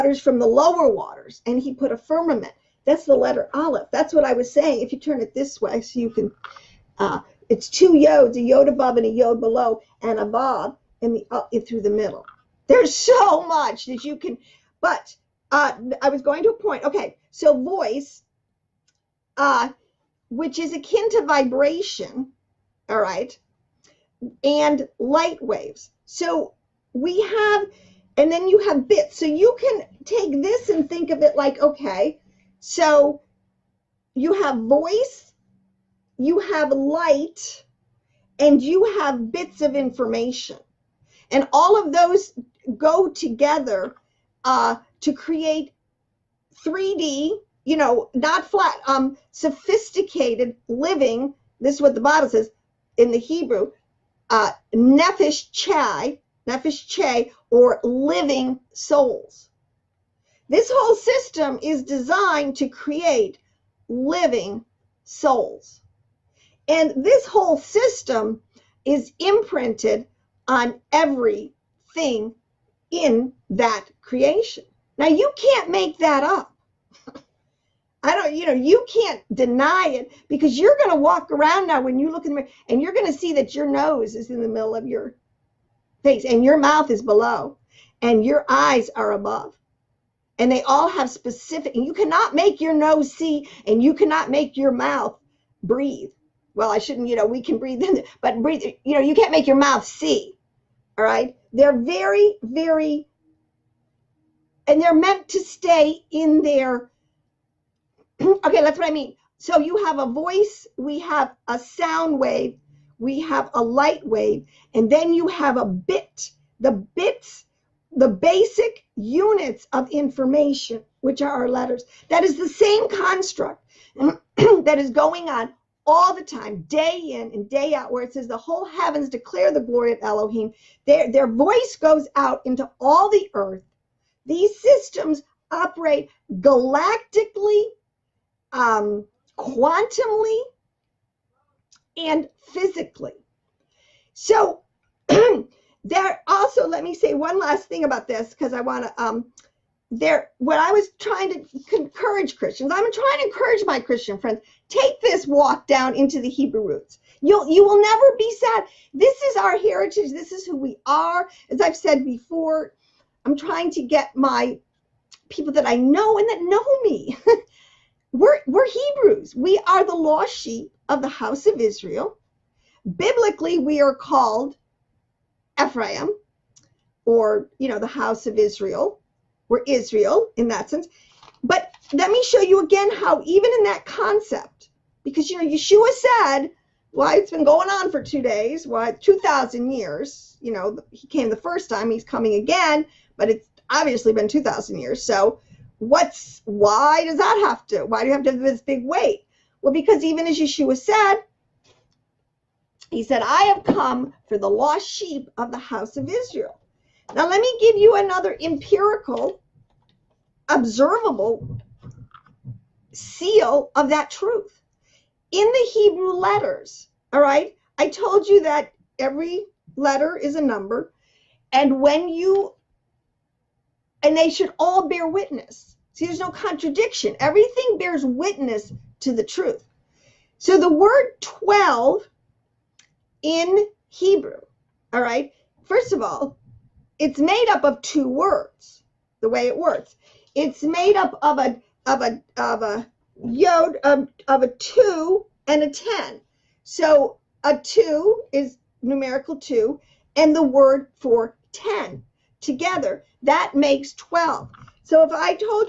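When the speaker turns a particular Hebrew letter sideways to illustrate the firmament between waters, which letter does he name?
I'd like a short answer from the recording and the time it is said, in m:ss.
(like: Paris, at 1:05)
aleph, at 0:03.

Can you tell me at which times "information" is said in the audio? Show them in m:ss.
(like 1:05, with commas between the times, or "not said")
0:39, 1:59.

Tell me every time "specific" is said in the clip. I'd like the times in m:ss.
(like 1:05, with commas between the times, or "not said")
1:31.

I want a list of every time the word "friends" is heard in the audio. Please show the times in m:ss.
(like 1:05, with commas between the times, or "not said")
2:34.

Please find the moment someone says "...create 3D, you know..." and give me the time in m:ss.
0:45.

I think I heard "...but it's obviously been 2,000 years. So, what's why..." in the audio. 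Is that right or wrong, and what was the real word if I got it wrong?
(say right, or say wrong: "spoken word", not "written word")
right.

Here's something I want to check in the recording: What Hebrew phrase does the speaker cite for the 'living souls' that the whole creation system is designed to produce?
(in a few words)
nefesh chai.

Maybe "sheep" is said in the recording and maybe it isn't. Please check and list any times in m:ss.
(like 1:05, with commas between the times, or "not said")
2:50, 3:24.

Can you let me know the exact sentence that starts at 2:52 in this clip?
Biblically, we are called Ephraim or you know the house of Israel were Israel in that sense.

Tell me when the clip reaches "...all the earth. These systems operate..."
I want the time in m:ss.
2:12.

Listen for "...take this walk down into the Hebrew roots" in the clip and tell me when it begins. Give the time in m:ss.
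2:34.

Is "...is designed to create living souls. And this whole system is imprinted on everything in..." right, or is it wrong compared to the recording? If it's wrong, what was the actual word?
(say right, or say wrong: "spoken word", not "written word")
right.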